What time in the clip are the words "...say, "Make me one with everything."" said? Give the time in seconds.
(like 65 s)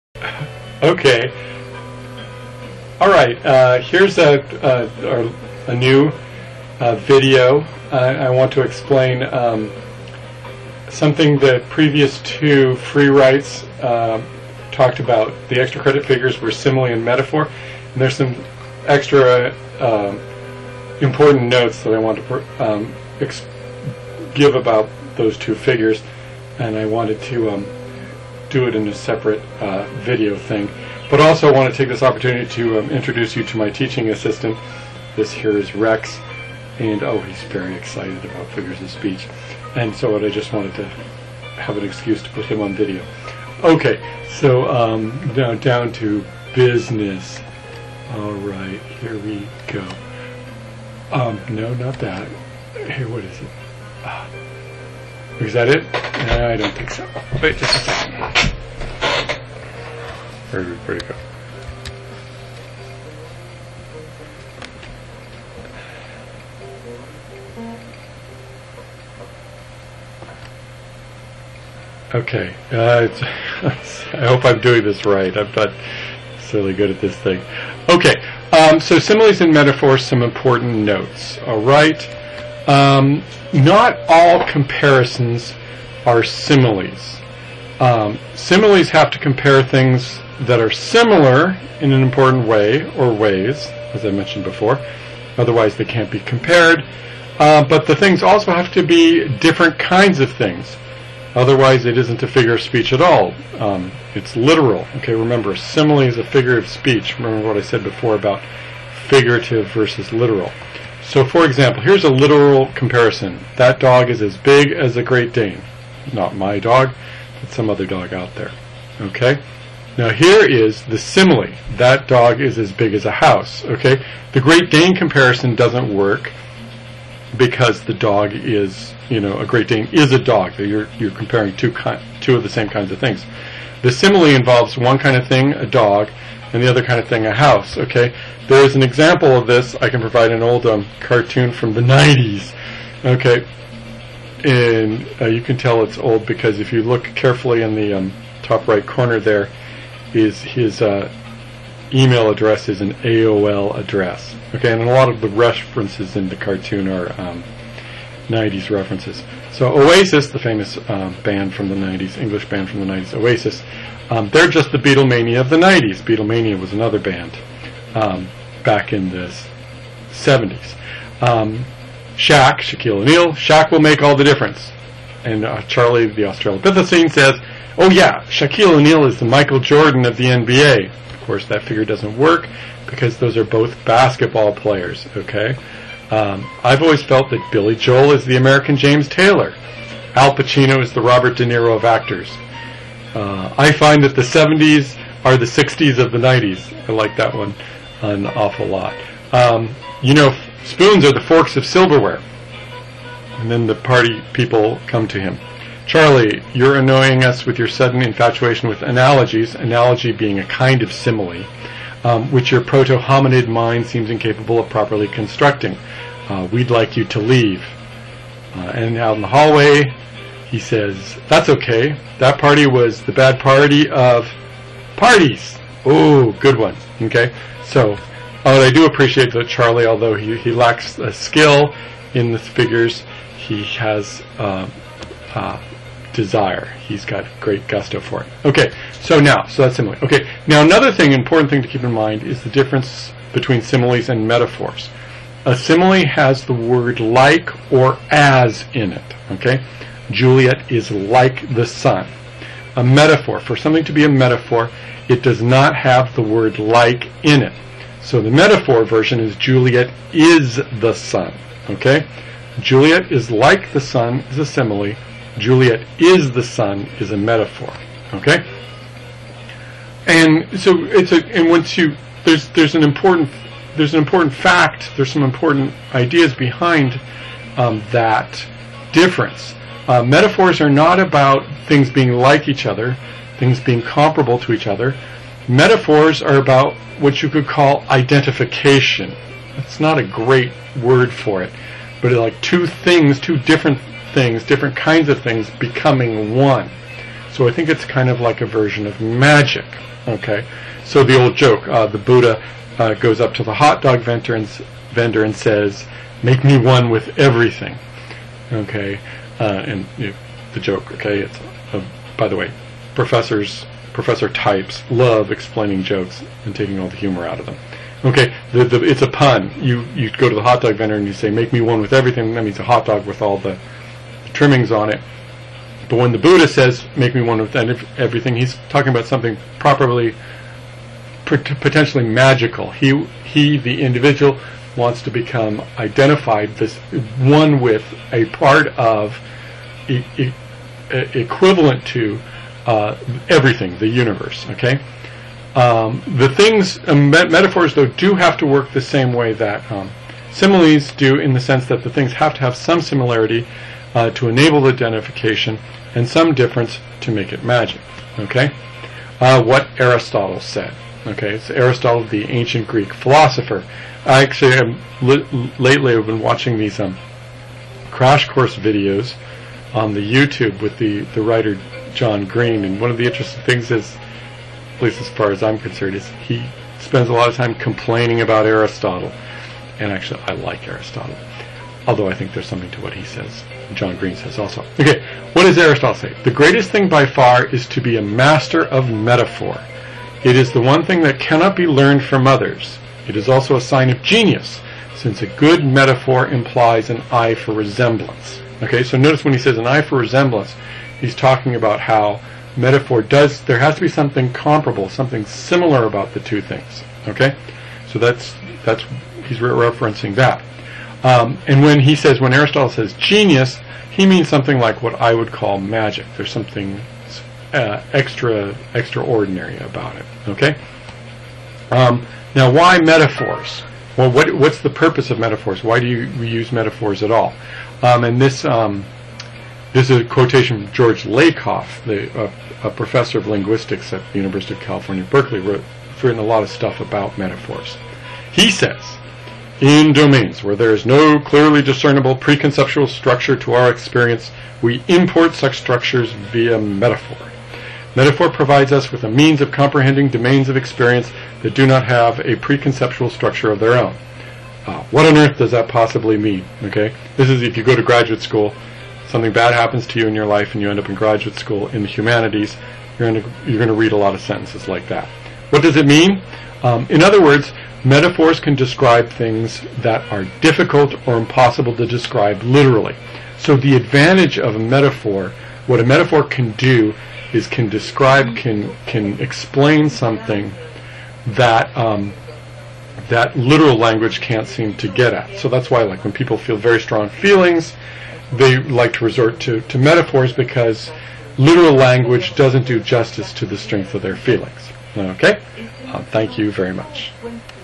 321 s.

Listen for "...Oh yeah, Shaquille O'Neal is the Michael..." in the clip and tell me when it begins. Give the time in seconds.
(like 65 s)
177 s.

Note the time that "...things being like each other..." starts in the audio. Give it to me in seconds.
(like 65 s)
281 s.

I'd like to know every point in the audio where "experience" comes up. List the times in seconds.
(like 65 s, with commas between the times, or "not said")
443 s, 450 s.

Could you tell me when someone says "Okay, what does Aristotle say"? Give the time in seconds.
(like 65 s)
384 s.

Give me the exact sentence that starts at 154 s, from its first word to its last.
Okay, and a lot of the references in the cartoon are um, 90s references.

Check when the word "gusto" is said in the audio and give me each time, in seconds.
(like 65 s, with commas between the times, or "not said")
237 s.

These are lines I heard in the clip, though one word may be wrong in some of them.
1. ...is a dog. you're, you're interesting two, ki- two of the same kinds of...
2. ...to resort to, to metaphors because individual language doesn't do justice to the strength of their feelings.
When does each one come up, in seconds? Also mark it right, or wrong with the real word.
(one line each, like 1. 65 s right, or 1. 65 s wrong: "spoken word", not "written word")
1. 129 s wrong: "comparing", not "interesting"
2. 488 s wrong: "literal", not "individual".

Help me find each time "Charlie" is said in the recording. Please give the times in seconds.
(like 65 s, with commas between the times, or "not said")
175 s, 205 s, 229 s.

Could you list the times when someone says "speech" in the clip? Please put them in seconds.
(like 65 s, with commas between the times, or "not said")
38 s, 102 s, 106 s.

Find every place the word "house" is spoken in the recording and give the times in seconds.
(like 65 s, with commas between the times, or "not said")
123 s, 137 s.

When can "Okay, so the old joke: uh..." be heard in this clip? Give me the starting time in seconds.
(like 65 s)
300 s.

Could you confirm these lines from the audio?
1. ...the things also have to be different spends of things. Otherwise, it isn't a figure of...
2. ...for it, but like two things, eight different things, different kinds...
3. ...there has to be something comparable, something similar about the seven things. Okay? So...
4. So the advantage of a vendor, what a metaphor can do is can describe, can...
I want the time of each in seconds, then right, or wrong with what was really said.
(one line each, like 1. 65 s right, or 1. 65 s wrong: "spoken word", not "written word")
1. 97 s wrong: "kinds", not "spends"
2. 291 s wrong: "two", not "eight"
3. 403 s wrong: "two", not "seven"
4. 473 s wrong: "metaphor", not "vendor".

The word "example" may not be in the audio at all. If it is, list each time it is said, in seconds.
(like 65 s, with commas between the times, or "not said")
111 s, 138 s.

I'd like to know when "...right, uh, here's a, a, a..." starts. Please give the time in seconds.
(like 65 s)
3 s.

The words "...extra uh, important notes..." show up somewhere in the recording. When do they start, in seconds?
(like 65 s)
18 s.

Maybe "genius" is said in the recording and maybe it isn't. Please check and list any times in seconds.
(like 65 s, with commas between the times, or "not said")
394 s, 412 s.